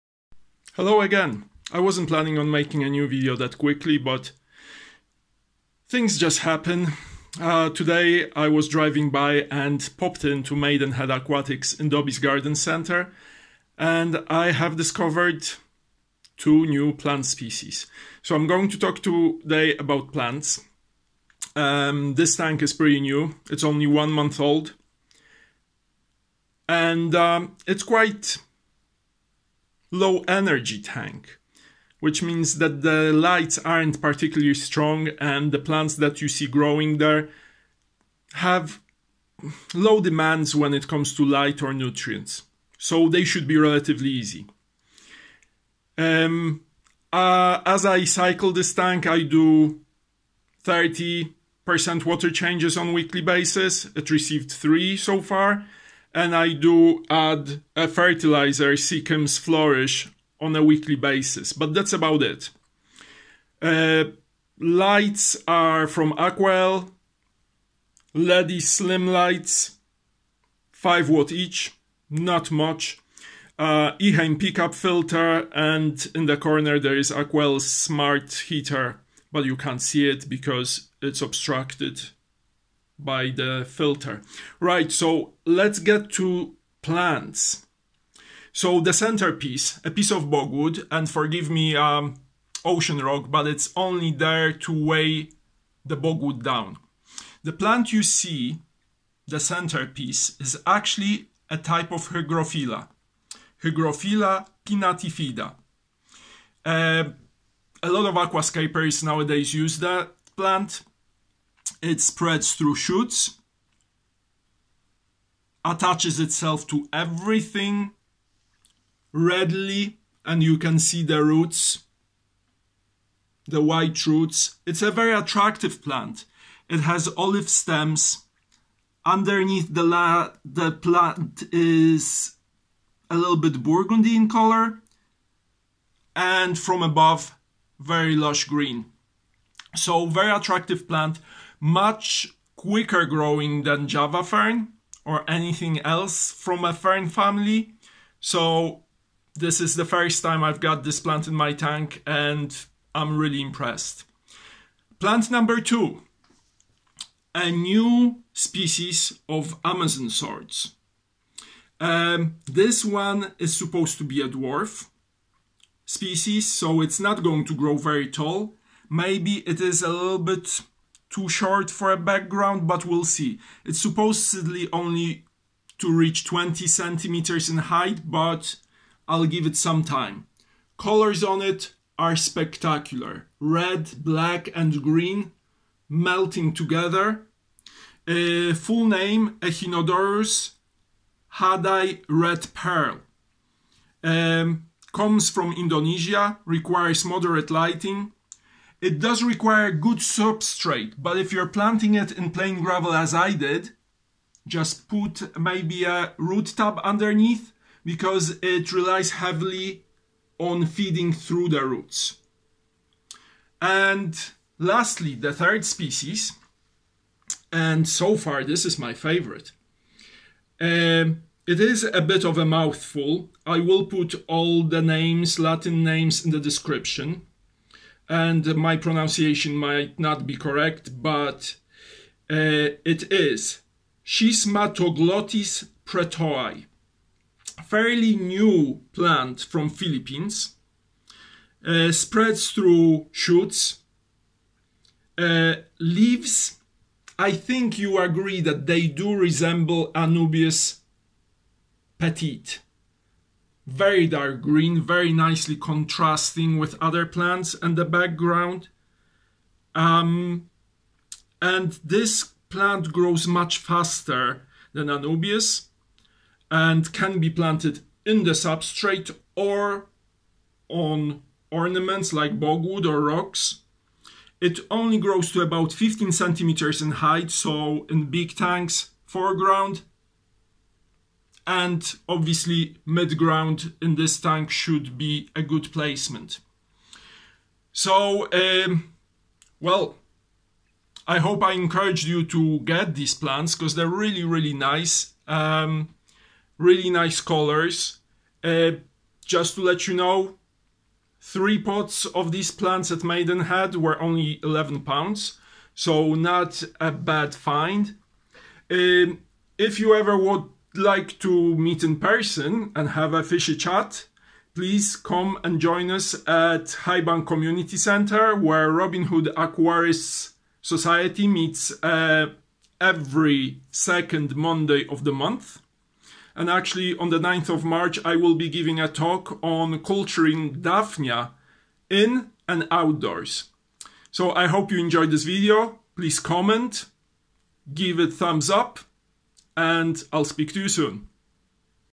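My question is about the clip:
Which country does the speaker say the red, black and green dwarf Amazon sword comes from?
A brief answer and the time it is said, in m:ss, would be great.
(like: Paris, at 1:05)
Indonesia, at 3:15.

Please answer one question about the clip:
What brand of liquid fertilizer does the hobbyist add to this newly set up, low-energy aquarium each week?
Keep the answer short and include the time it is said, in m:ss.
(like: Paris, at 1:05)
Seachem's Flourish, at 0:58.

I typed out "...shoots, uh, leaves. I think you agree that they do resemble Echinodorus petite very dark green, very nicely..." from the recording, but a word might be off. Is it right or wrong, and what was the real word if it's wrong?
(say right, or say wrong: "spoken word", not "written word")
wrong: "Anubias", not "Echinodorus".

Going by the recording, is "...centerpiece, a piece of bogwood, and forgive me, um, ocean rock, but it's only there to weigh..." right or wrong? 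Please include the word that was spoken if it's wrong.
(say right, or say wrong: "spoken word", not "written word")
right.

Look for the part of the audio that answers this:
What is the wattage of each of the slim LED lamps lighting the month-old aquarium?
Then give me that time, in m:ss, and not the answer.
1:10.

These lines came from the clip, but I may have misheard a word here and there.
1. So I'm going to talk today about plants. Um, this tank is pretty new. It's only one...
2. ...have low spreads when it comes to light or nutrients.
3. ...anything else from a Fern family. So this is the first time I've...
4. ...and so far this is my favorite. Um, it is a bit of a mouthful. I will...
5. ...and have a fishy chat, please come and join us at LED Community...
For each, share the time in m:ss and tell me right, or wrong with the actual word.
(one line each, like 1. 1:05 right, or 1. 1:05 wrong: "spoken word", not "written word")
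1. 0:18 right
2. 0:38 wrong: "demands", not "spreads"
3. 2:25 right
4. 3:37 right
5. 5:12 wrong: "Highbank", not "LED".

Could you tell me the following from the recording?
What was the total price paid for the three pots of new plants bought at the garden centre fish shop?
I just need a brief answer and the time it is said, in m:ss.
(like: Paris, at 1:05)
11 pounds, at 5:04.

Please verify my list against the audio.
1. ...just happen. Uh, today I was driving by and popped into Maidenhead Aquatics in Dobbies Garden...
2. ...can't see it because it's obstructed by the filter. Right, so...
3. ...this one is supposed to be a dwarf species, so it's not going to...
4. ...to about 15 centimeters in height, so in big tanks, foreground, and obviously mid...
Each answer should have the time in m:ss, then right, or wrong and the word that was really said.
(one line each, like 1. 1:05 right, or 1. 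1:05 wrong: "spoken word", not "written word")
1. 0:06 right
2. 1:19 right
3. 2:42 right
4. 4:35 right.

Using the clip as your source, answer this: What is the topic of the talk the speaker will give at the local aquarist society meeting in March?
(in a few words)
Culturing Daphnia.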